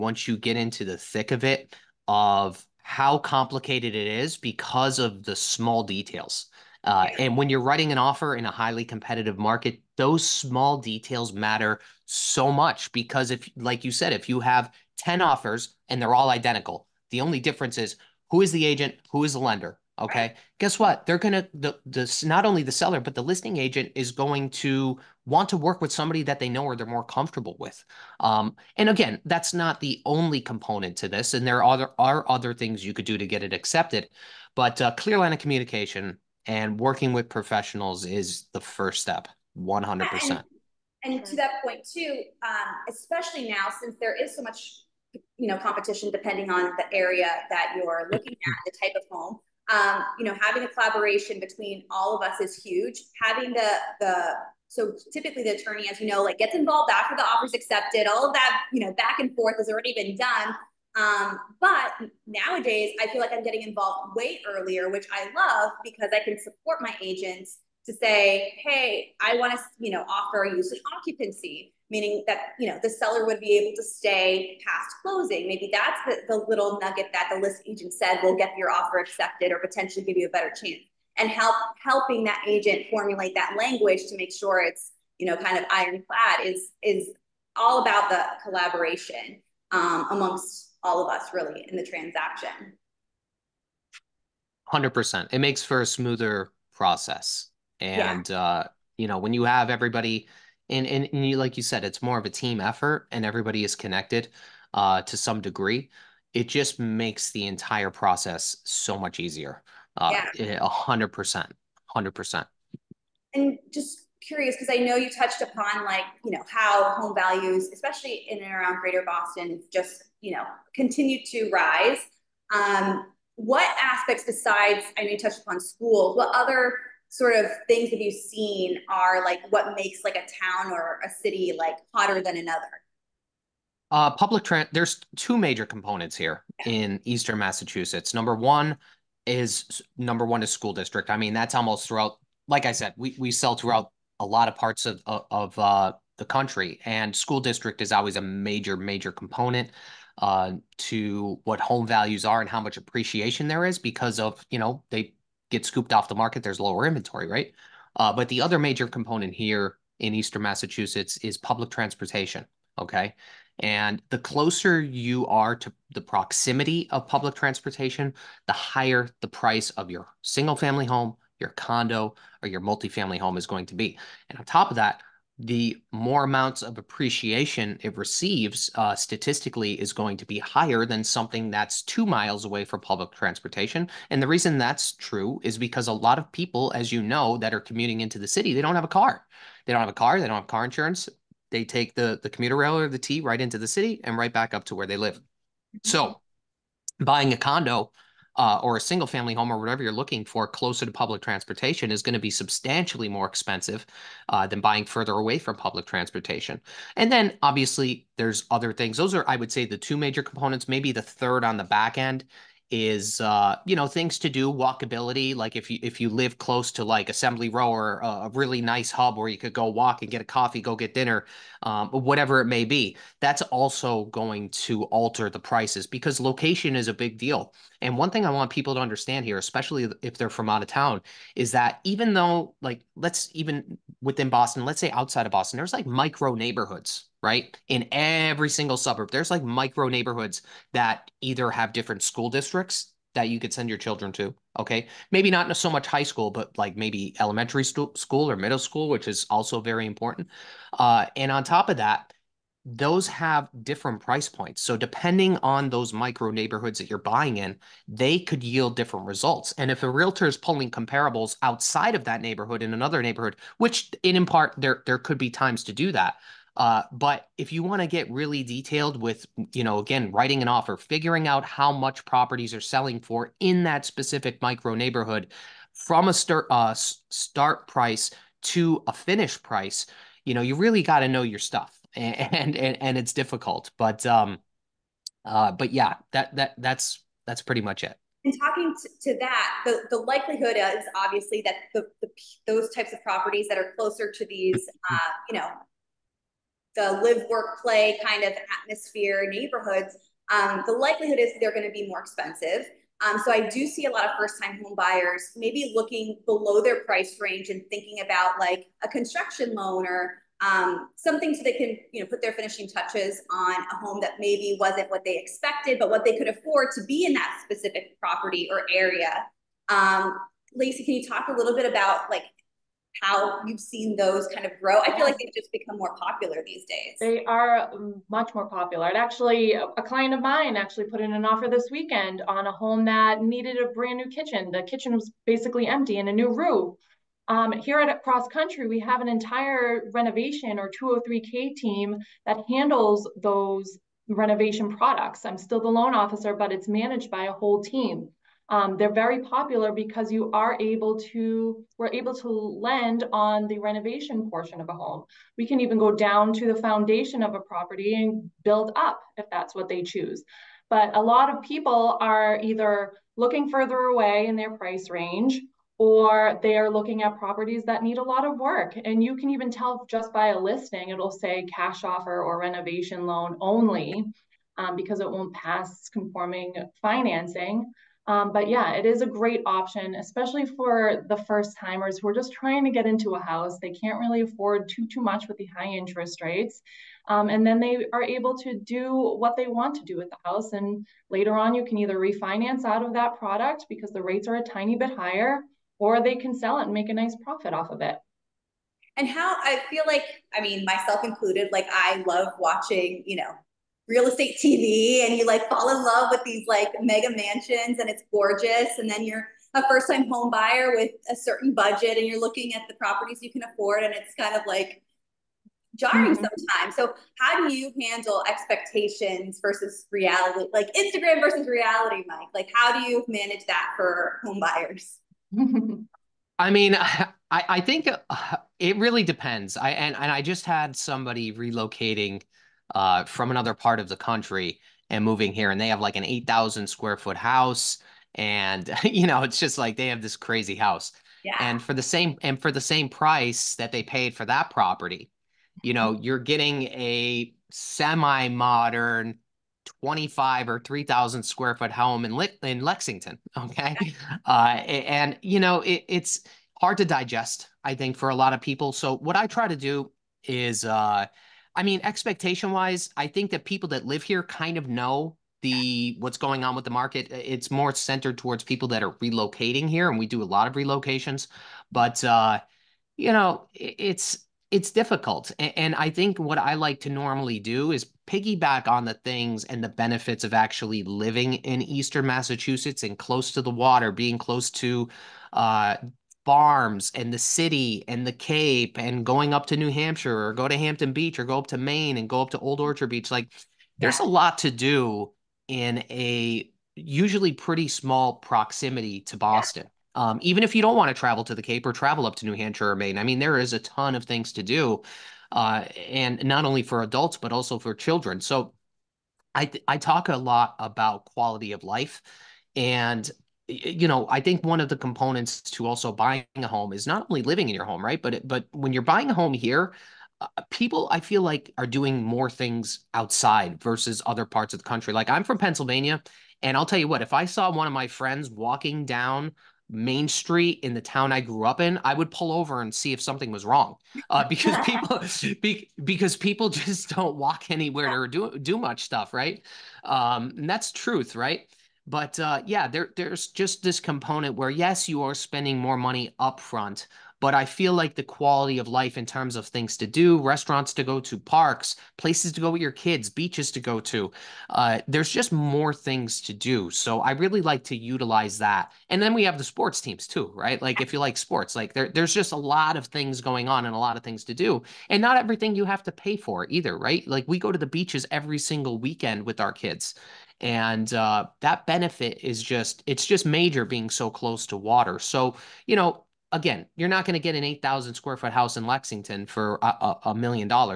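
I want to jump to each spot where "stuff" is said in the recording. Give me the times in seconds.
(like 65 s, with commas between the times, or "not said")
281 s, 538 s.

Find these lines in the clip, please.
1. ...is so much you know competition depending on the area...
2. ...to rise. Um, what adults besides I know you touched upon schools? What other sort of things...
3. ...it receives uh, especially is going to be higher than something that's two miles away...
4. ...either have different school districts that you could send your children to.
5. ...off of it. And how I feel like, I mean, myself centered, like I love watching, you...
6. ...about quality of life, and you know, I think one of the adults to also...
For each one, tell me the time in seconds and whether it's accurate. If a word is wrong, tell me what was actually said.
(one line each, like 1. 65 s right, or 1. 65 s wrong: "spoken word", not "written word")
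1. 44 s right
2. 121 s wrong: "aspects", not "adults"
3. 177 s wrong: "statistically", not "especially"
4. 241 s right
5. 397 s wrong: "included", not "centered"
6. 510 s wrong: "components", not "adults".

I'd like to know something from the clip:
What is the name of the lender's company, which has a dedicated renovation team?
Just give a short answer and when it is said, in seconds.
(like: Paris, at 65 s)
Cross Country, at 338 s.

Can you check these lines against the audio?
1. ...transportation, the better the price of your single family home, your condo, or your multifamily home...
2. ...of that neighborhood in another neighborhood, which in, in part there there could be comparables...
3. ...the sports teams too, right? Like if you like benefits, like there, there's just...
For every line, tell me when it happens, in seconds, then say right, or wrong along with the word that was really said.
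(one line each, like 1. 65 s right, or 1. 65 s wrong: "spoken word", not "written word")
1. 167 s wrong: "higher", not "better"
2. 261 s wrong: "times", not "comparables"
3. 559 s wrong: "sports", not "benefits".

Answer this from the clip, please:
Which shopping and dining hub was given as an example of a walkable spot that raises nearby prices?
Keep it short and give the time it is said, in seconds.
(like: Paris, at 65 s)
Assembly Row, at 217 s.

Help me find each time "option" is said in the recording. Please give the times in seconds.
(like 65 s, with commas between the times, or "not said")
379 s.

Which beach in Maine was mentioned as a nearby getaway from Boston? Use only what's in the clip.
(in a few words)
Old Orchard Beach.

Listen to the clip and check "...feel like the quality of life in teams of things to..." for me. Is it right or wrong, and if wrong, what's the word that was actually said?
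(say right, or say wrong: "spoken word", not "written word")
wrong: "terms", not "teams".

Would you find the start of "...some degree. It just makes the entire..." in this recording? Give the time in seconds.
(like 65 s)
105 s.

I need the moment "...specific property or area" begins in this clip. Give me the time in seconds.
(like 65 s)
317 s.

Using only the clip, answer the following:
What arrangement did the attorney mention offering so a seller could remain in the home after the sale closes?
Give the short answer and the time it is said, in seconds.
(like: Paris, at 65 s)
Use and occupancy, at 70 s.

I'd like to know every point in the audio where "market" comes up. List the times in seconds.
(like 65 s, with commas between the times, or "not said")
9 s, 156 s, 466 s.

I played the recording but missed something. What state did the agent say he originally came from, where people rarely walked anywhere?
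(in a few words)
Pennsylvania.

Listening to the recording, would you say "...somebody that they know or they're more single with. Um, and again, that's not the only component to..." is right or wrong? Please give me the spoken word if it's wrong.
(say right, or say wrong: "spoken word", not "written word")
wrong: "comfortable", not "single".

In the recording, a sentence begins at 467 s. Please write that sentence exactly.
It's more centered towards people that are relocating here, and we do a lot of relocations.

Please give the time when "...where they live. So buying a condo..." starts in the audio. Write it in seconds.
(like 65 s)
194 s.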